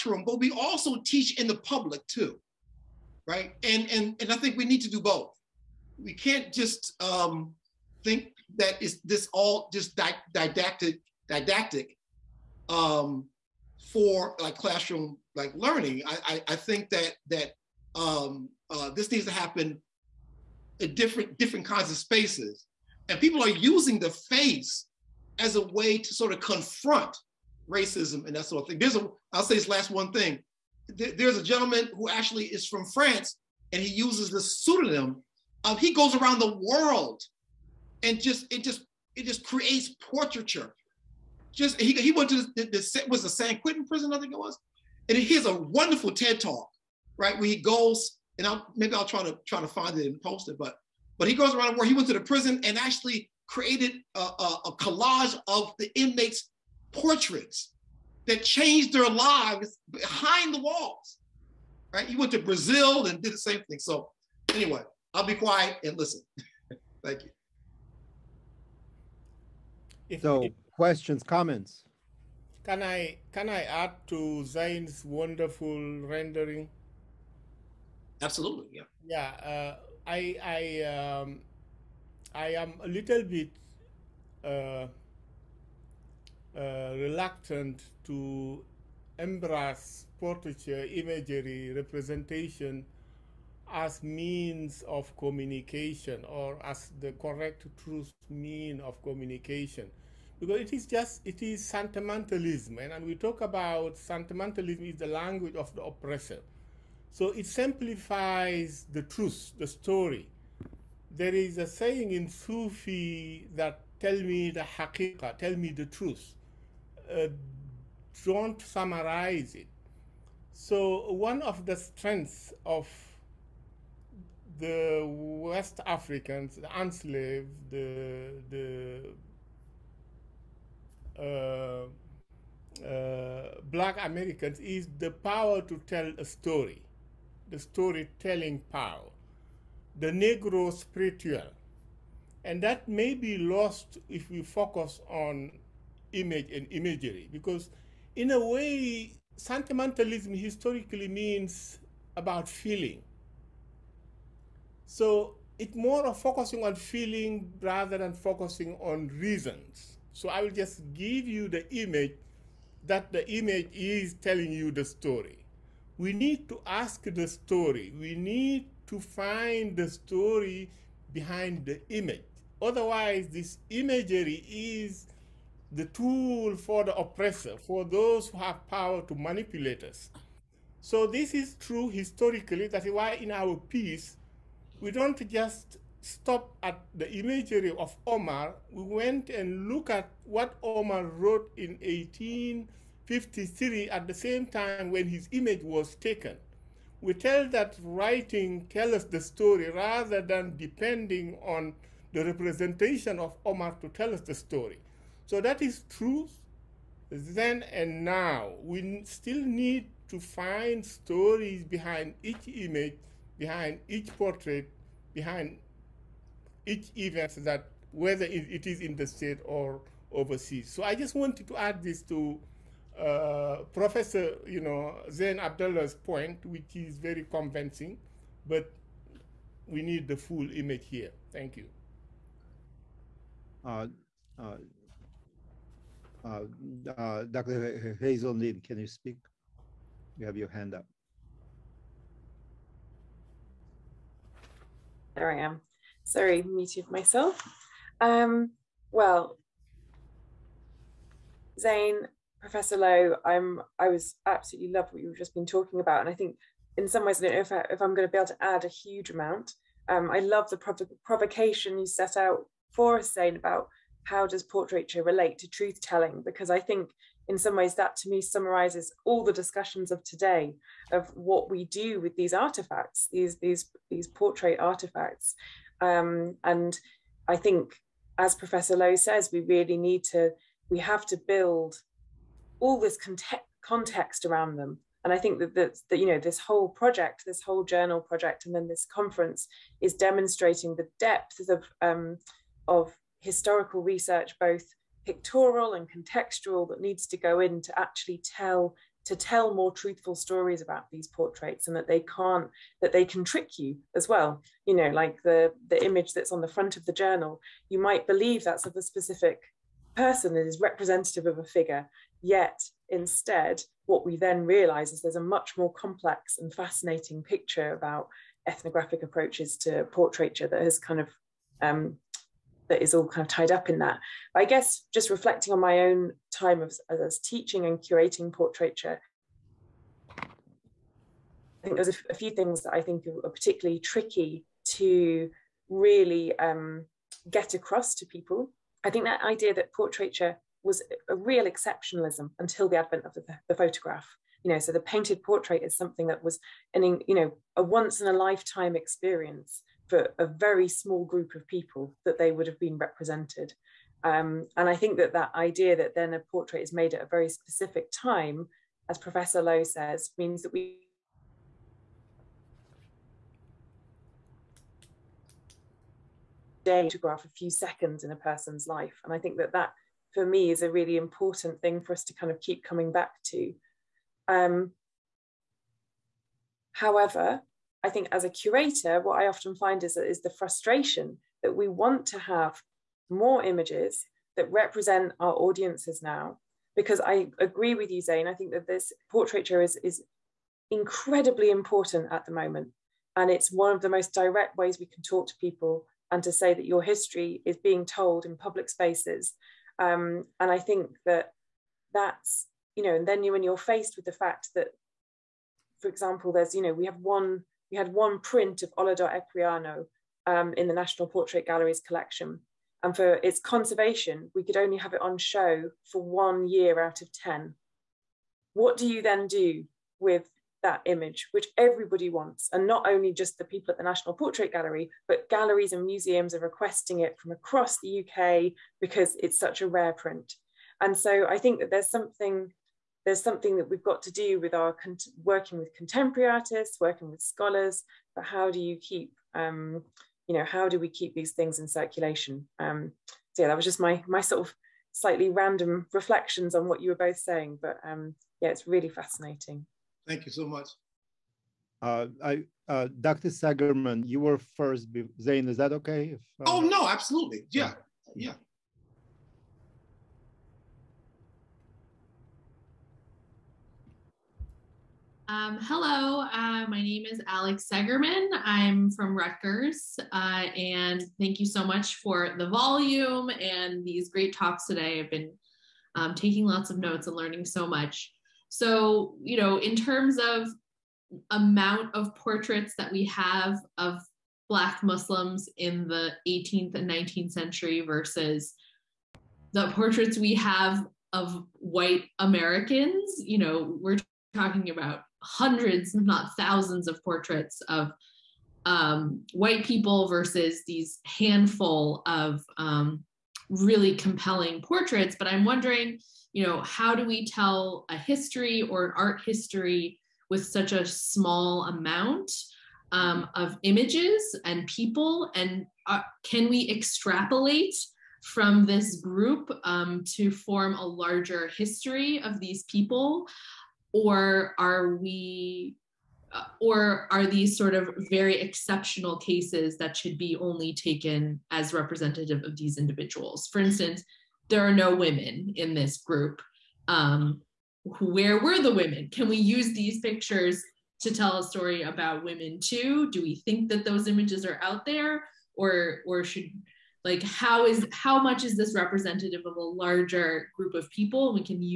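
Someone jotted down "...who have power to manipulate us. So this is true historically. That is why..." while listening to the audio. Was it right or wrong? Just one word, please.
right.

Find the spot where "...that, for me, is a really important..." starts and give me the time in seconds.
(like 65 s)
369 s.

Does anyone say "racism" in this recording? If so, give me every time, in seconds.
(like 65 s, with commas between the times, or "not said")
27 s.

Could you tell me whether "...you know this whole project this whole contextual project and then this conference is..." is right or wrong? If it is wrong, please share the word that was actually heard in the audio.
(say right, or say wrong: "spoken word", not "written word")
wrong: "journal", not "contextual".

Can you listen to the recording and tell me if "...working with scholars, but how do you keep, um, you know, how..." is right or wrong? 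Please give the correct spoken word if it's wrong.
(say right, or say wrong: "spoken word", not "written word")
right.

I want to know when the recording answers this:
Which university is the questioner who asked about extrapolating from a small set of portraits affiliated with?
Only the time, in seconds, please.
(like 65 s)
469 s.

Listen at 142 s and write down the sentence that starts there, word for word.
And that may be lost if we focus on image and imagery, because in a way, sentimentalism historically means about feeling.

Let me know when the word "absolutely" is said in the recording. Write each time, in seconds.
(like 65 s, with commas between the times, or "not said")
78 s, 254 s, 456 s.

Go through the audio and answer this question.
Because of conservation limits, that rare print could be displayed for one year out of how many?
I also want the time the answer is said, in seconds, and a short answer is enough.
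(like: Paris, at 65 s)
10, at 417 s.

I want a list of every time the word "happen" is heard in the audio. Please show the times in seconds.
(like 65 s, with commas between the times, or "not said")
19 s.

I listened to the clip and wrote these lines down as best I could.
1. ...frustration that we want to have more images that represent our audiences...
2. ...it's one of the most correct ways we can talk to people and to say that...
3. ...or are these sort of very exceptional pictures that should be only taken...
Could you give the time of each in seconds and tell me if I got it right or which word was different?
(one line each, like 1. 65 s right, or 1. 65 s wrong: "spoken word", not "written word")
1. 380 s right
2. 393 s wrong: "direct", not "correct"
3. 526 s wrong: "cases", not "pictures".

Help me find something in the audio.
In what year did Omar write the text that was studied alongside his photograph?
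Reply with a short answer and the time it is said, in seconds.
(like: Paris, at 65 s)
1853, at 191 s.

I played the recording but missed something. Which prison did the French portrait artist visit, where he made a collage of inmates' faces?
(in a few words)
San Quentin.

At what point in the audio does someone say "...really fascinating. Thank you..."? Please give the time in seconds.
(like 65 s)
448 s.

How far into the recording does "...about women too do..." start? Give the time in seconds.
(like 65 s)
541 s.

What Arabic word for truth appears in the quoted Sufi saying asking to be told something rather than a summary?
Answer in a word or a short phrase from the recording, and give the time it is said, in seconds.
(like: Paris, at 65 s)
hakeka, at 114 s.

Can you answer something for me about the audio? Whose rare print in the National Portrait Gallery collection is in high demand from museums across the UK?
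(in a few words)
Olaudah Equiano.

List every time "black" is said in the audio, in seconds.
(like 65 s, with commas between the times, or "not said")
133 s, 484 s.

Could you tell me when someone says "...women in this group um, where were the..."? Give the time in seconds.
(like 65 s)
534 s.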